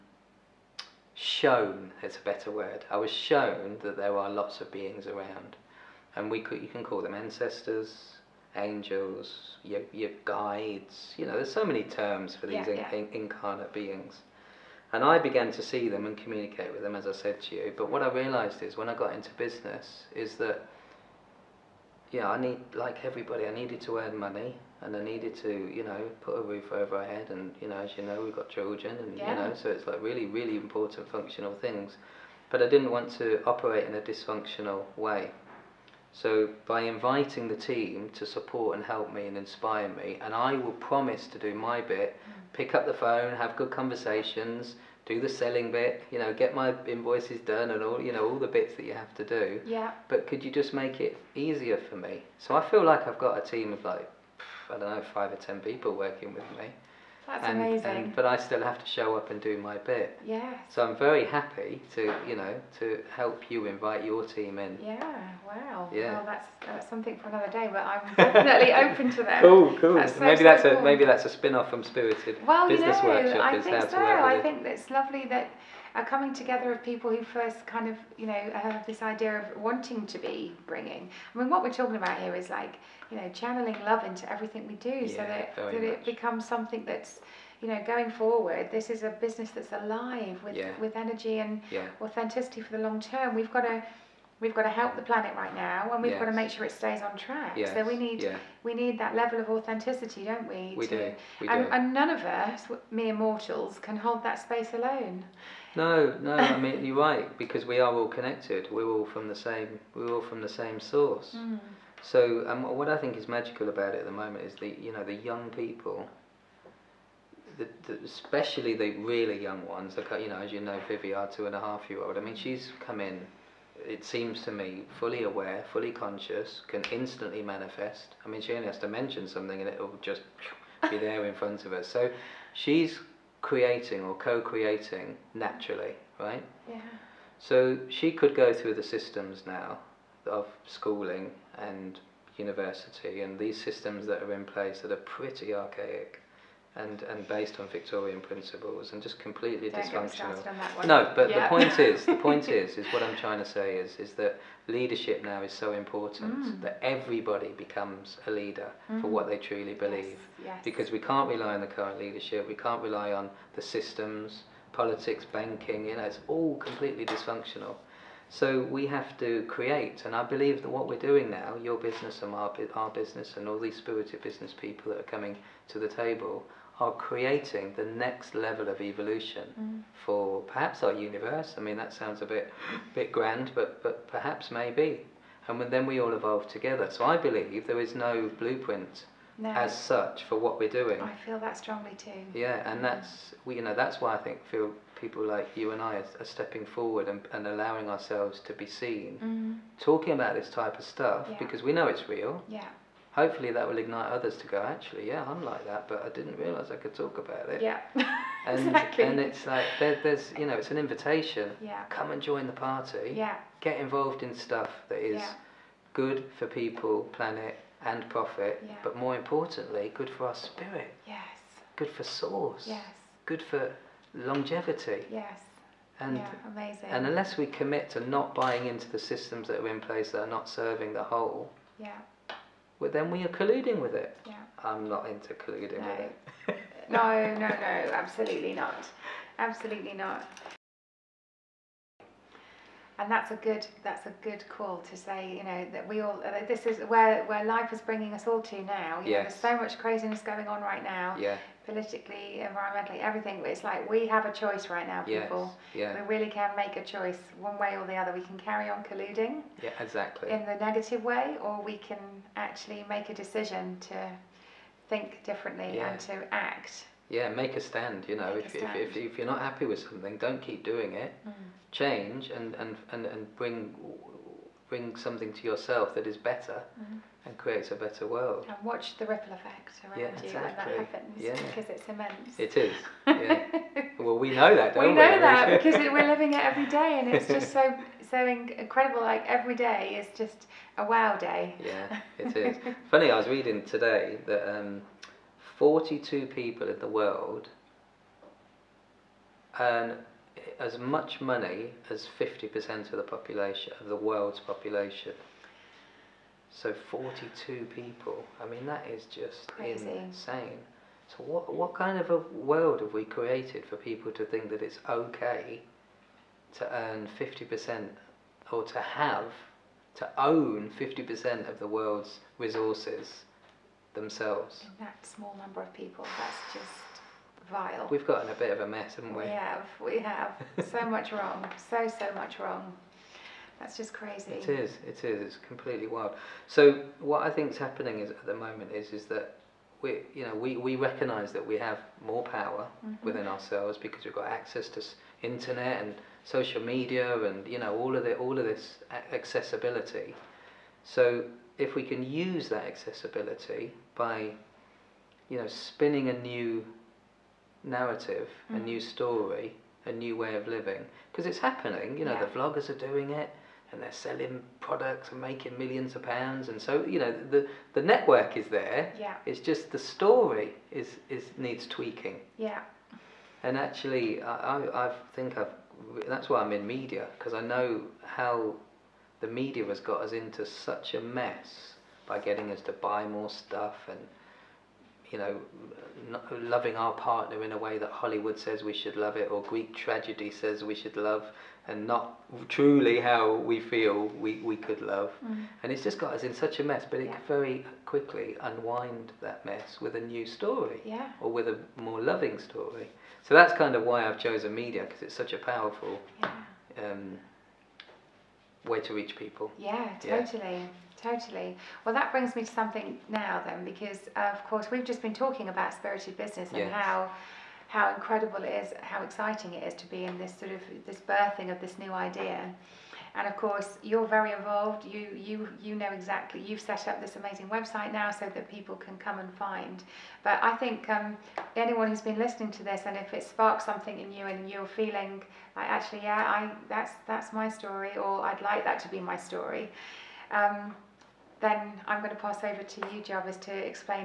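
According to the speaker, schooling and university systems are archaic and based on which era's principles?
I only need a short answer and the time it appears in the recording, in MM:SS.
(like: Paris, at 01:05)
Victorian, at 02:27.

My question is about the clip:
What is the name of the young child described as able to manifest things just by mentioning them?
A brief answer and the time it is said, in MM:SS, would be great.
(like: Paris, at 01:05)
Vivi, at 02:00.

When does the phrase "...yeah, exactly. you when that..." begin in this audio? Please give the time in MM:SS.
04:39.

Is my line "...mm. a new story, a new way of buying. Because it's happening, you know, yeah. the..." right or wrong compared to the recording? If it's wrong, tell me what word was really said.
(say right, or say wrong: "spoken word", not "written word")
wrong: "living", not "buying".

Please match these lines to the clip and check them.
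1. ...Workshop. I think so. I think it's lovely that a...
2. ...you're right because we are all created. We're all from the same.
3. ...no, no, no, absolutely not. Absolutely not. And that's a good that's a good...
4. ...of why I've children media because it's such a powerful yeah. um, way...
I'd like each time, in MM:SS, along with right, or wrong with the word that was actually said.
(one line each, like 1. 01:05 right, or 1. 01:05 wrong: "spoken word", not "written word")
1. 01:13 right
2. 01:46 wrong: "connected", not "created"
3. 03:56 right
4. 06:43 wrong: "chosen", not "children".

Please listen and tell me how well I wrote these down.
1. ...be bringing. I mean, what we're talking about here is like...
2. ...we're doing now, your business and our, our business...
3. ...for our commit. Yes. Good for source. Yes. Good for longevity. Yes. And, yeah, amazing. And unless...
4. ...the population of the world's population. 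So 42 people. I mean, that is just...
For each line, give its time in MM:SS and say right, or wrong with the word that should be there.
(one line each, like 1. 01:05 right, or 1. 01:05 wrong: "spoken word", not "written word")
1. 01:20 right
2. 02:50 right
3. 03:40 wrong: "spirit", not "commit"
4. 05:02 right.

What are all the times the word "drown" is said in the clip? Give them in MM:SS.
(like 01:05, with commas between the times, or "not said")
not said.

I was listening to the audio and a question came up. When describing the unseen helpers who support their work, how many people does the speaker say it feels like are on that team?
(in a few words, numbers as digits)
5 or 10.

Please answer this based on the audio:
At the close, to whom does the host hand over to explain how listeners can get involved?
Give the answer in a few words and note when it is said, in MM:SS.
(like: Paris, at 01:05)
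Jarvis, at 07:23.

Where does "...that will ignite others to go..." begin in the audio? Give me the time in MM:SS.
03:23.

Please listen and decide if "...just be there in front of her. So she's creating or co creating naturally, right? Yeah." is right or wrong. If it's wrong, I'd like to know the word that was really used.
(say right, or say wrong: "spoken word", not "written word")
right.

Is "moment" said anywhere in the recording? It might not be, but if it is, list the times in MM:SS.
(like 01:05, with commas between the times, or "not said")
01:54, 05:38.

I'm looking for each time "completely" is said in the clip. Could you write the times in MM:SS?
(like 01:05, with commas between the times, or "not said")
02:29, 02:46, 05:35.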